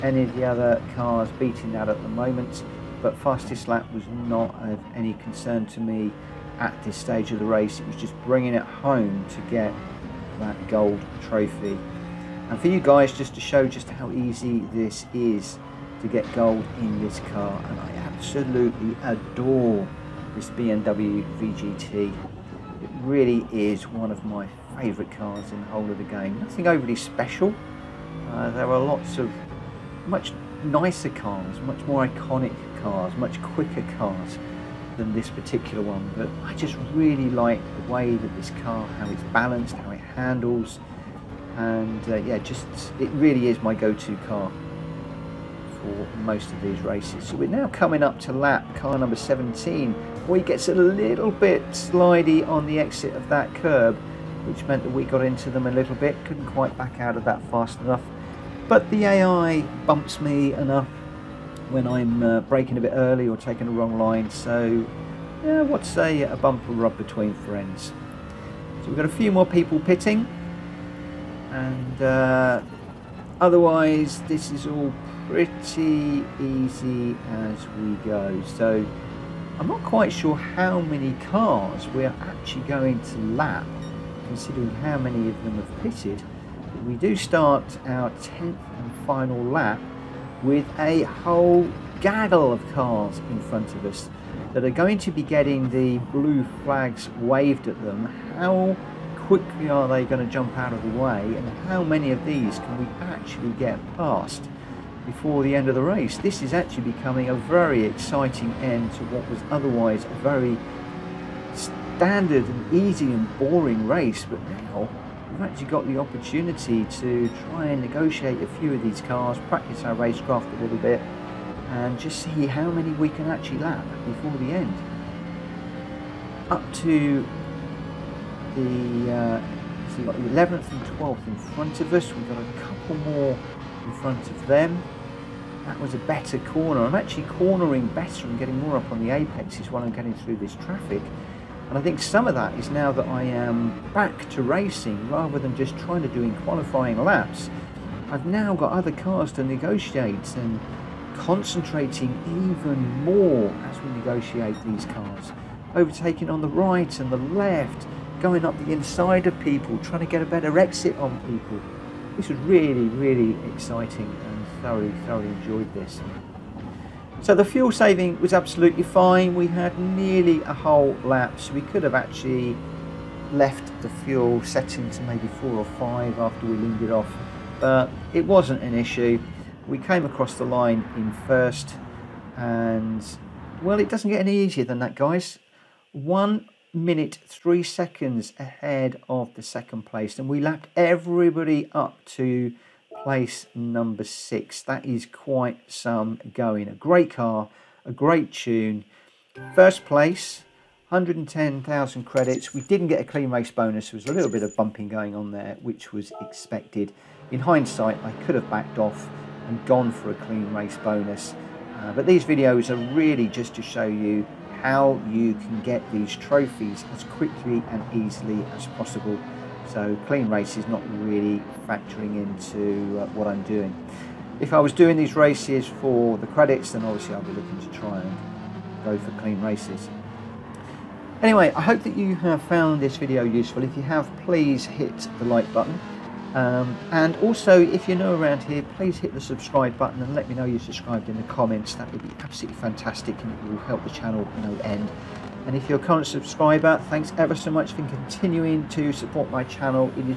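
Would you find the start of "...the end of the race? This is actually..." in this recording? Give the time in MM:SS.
01:45.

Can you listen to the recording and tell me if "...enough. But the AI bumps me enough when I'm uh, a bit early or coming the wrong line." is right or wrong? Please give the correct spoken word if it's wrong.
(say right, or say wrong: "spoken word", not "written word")
wrong: "taking", not "coming".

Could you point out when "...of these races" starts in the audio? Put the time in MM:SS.
00:46.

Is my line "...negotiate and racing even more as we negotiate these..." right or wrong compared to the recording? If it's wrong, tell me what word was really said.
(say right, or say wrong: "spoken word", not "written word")
wrong: "concentrating", not "racing".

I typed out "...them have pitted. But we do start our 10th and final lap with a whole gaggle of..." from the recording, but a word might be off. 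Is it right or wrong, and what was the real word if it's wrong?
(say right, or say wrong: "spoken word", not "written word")
right.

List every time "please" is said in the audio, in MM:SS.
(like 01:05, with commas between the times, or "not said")
03:54, 03:58.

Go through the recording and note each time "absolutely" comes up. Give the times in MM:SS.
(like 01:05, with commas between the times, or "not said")
00:18, 02:48, 04:02.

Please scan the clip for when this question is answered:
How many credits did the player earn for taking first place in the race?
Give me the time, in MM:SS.
03:20.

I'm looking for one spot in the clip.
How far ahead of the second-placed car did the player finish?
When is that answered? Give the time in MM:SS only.
03:05.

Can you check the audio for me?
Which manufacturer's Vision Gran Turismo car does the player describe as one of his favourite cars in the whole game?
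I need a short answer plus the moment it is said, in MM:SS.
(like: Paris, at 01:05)
BMW, at 00:20.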